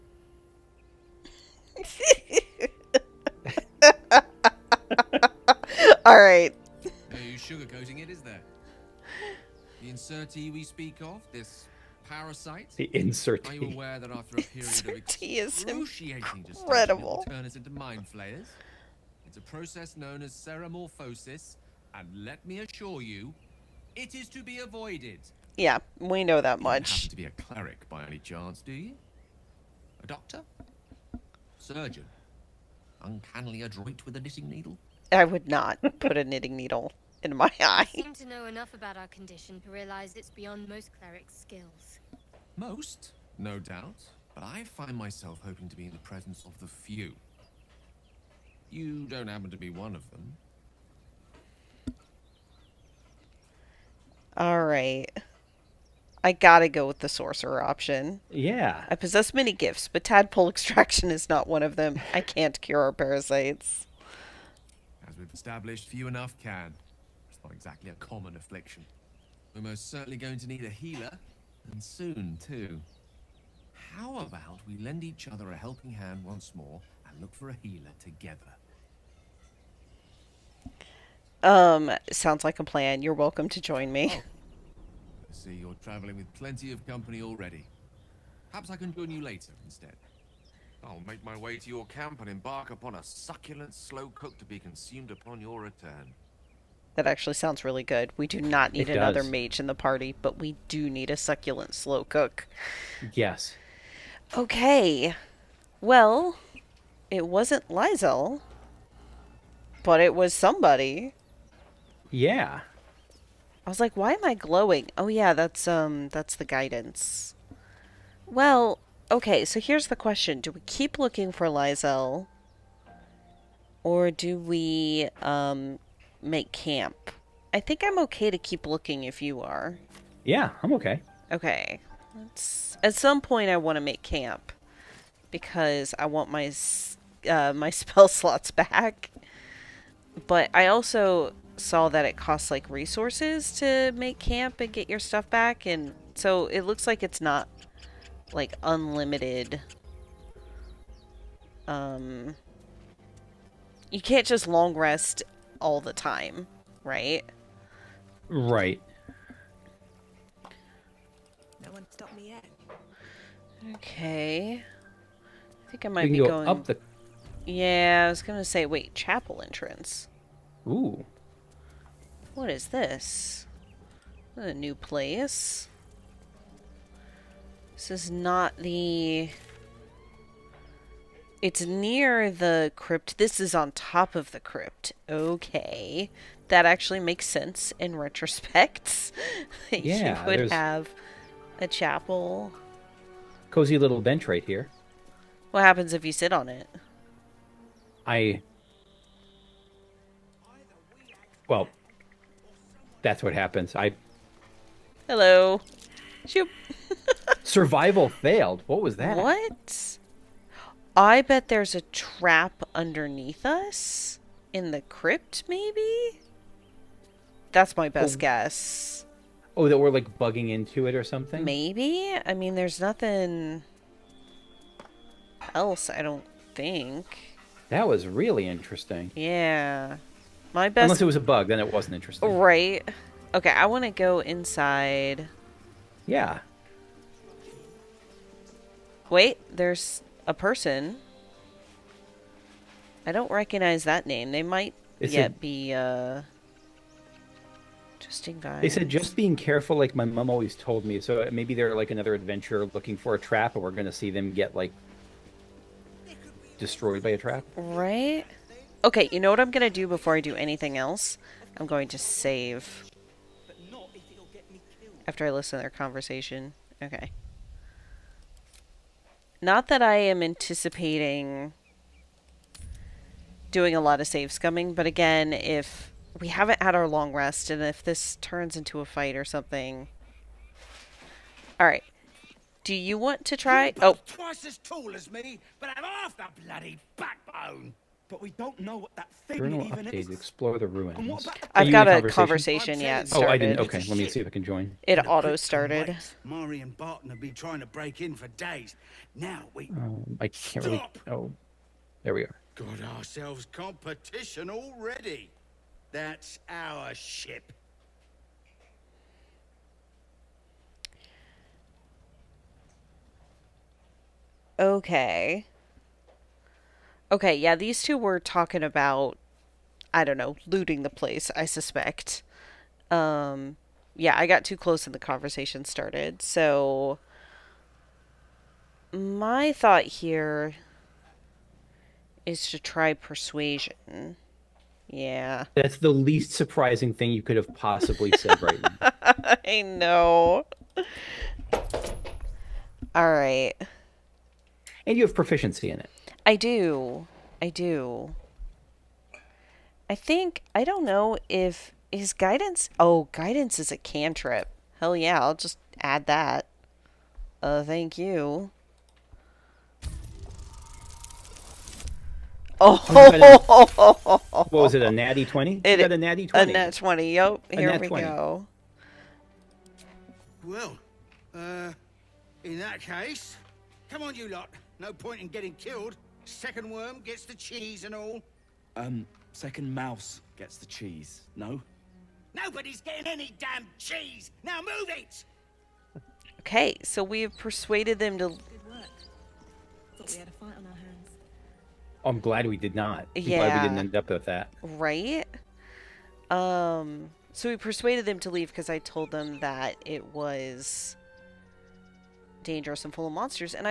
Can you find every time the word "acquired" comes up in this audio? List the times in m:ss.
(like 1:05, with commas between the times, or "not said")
not said.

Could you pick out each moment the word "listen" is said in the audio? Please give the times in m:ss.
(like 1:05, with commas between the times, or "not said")
4:25.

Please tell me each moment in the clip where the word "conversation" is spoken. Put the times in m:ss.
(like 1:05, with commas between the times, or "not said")
4:25, 4:52, 5:24.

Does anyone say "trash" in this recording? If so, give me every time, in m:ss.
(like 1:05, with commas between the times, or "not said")
not said.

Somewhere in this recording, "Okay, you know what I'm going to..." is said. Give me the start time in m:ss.
4:18.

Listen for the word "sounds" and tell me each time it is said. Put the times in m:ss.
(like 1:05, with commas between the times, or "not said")
1:22, 1:37.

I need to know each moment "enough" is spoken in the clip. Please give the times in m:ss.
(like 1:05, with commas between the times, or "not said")
0:38, 1:06.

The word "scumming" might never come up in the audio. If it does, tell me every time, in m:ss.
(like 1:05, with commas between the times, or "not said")
4:34.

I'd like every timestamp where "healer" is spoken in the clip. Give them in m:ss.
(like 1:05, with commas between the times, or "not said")
1:10, 1:17.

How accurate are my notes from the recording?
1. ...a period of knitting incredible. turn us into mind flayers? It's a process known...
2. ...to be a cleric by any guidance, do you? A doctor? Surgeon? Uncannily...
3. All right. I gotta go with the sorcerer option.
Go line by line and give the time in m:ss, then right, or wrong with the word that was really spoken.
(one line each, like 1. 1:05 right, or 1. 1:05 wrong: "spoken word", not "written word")
1. 0:14 wrong: "excruciating", not "knitting"
2. 0:27 wrong: "chance", not "guidance"
3. 0:54 right.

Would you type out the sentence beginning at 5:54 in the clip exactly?
Hell yeah, I'll just add that.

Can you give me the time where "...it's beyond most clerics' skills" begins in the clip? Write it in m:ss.
0:40.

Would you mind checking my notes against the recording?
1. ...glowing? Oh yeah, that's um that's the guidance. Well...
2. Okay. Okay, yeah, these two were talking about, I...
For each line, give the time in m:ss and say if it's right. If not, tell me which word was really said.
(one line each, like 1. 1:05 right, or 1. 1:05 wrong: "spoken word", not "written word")
1. 1:54 right
2. 5:14 right.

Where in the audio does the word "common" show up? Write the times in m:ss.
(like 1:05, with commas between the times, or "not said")
1:07.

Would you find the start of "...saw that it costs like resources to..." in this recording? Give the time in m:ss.
2:21.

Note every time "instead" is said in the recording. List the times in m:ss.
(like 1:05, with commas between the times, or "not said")
1:29.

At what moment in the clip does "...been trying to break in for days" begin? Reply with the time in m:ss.
4:57.